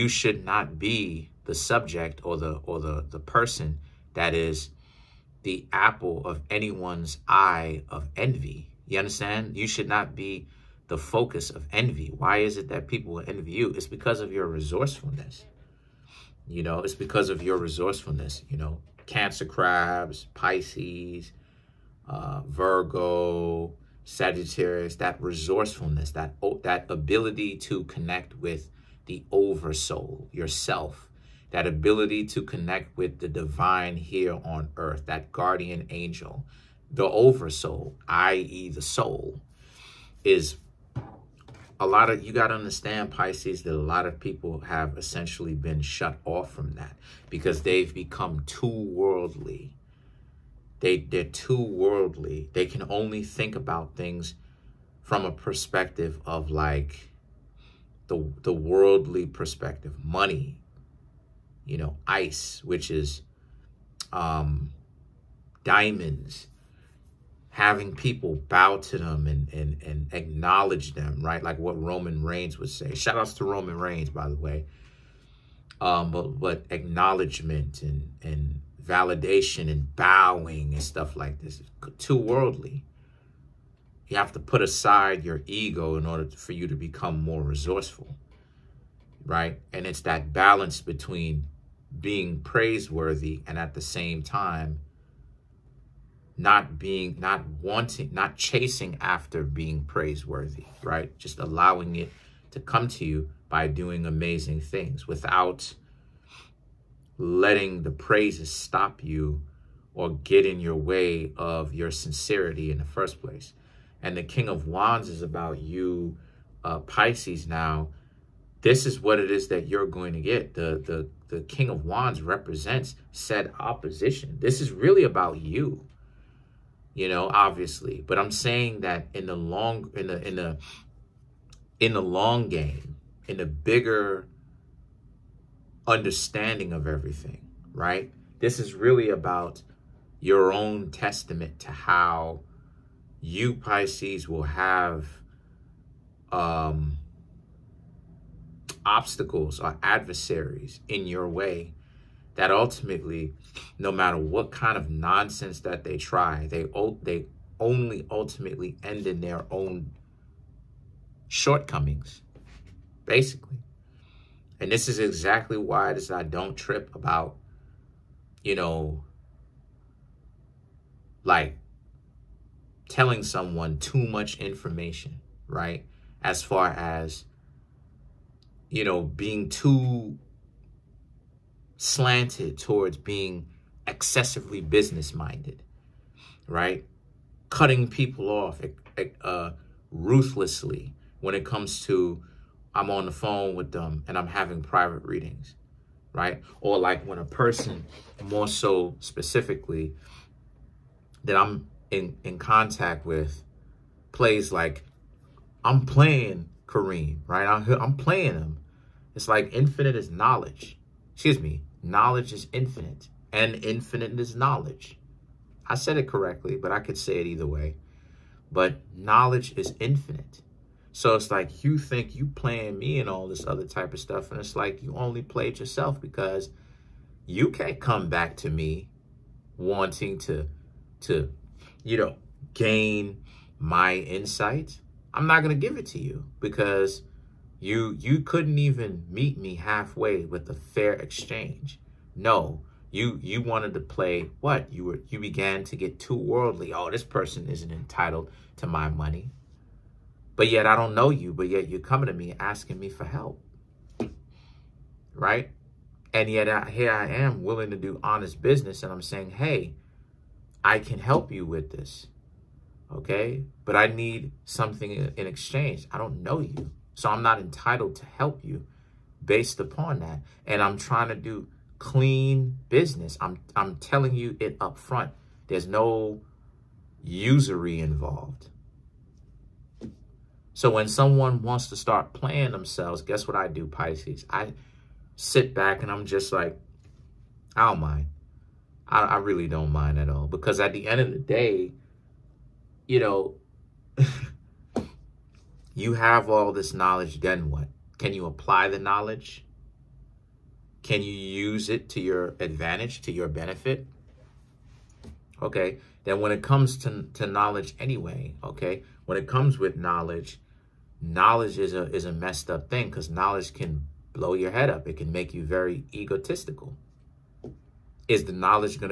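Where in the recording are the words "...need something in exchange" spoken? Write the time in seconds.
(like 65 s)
263 s.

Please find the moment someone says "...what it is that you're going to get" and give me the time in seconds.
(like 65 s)
118 s.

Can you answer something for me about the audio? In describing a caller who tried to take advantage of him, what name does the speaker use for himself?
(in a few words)
Kareem.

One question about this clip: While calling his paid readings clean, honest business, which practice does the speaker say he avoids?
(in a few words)
Usury.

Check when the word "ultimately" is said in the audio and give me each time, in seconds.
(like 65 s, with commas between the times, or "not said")
152 s, 158 s.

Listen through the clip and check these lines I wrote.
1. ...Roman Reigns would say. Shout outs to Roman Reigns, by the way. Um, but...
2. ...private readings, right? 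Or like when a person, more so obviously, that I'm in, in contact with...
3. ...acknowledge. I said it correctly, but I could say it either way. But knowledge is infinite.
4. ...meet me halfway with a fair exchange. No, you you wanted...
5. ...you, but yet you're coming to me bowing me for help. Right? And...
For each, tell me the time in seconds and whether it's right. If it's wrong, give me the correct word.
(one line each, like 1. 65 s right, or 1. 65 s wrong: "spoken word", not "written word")
1. 71 s right
2. 194 s wrong: "specifically", not "obviously"
3. 214 s wrong: "knowledge", not "acknowledge"
4. 239 s right
5. 251 s wrong: "asking", not "bowing".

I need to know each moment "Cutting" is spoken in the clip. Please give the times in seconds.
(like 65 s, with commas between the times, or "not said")
187 s.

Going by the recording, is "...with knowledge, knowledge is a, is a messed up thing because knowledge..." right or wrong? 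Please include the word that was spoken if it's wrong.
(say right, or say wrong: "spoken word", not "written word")
right.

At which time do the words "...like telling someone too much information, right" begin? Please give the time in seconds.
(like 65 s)
171 s.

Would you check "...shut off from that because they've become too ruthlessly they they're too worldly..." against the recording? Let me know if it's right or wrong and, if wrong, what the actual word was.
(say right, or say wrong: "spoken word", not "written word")
wrong: "worldly", not "ruthlessly".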